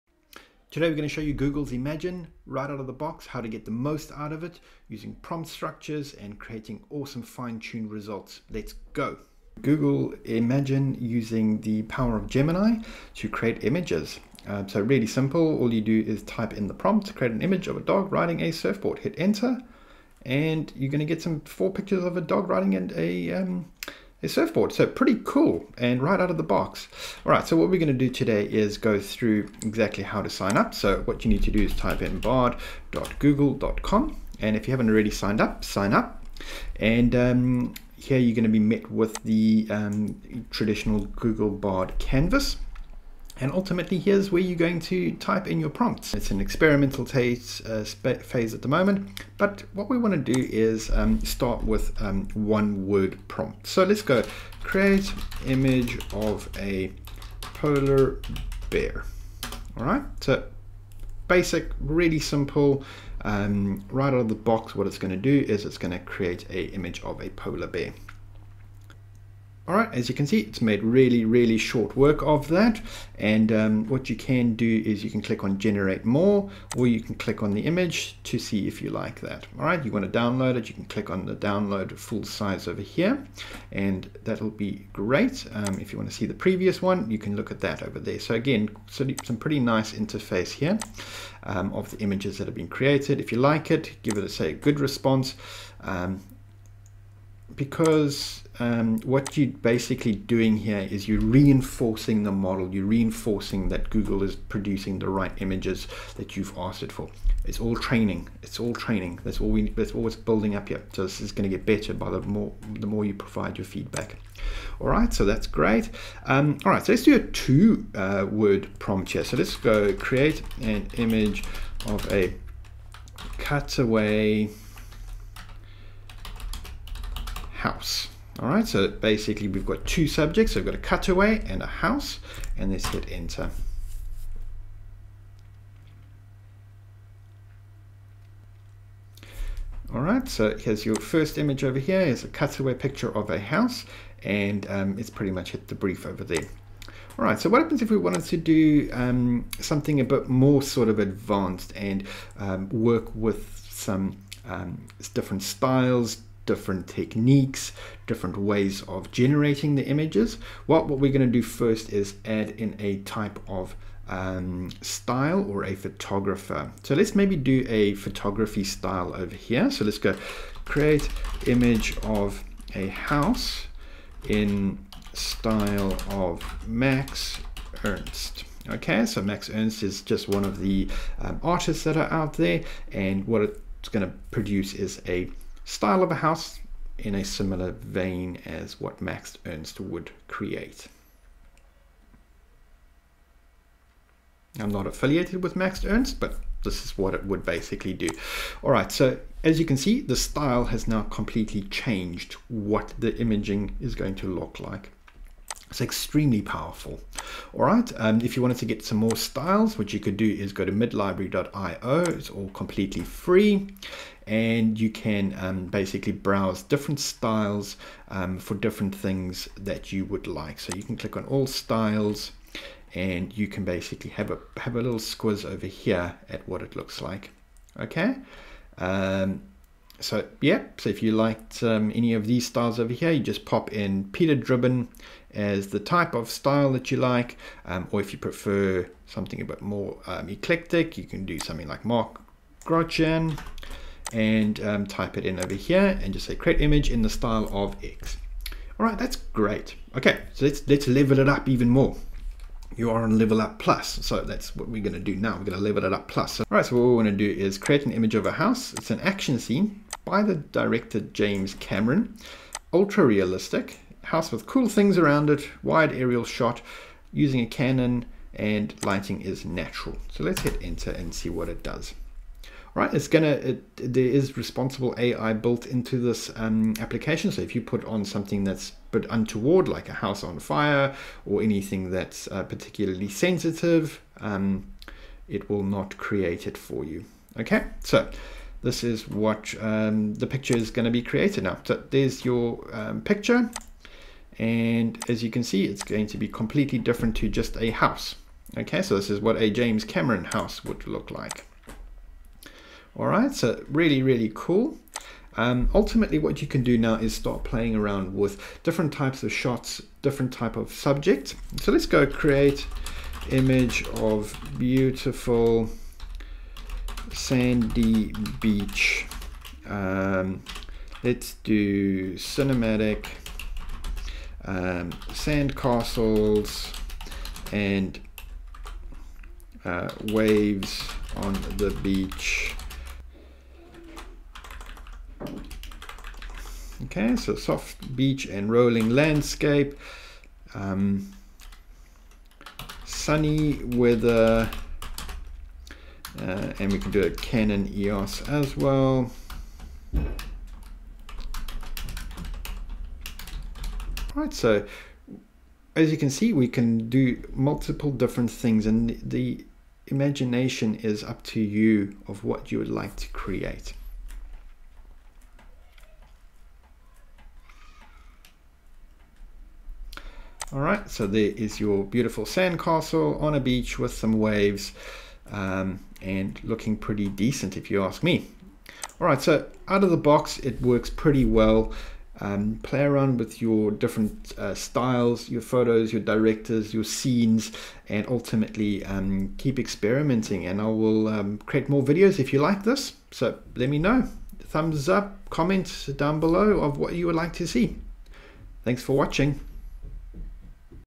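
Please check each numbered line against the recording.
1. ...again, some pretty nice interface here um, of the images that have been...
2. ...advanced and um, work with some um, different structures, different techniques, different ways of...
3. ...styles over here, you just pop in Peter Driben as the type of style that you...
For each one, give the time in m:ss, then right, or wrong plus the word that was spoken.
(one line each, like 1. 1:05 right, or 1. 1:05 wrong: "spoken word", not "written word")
1. 1:28 right
2. 2:30 wrong: "styles", not "structures"
3. 3:52 right.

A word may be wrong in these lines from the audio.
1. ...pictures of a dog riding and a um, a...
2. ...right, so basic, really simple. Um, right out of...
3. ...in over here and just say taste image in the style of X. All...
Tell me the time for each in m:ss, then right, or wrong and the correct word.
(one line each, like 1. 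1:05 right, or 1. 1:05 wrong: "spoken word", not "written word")
1. 0:21 right
2. 0:59 right
3. 4:05 wrong: "create", not "taste".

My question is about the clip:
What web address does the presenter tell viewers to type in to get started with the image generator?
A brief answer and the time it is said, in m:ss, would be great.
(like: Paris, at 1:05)
bard.google.com, at 0:32.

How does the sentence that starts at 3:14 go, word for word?
I'm not affiliated with Max Ernst, but this is what it would basically do.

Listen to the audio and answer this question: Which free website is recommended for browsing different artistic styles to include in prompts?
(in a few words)
midlibrary.io.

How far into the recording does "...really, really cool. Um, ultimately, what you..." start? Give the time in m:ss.
5:03.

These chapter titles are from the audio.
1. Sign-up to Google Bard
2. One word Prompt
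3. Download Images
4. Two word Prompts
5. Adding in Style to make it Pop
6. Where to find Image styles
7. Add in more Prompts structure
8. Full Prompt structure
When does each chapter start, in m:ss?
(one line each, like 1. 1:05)
1. 0:30
2. 0:50
3. 1:20
4. 1:57
5. 2:36
6. 3:31
7. 4:16
8. 6:21.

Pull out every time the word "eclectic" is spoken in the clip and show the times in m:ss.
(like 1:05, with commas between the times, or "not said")
4:00.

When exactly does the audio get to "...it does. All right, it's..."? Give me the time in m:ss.
4:31.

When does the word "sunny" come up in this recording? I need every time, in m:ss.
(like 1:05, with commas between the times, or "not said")
5:42.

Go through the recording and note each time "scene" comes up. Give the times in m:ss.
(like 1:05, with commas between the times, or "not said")
4:19, 6:26.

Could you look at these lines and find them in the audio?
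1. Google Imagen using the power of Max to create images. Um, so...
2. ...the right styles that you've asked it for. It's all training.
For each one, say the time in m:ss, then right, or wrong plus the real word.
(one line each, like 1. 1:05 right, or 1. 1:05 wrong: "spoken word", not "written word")
1. 0:09 wrong: "Gemini", not "Max"
2. 1:44 wrong: "images", not "styles".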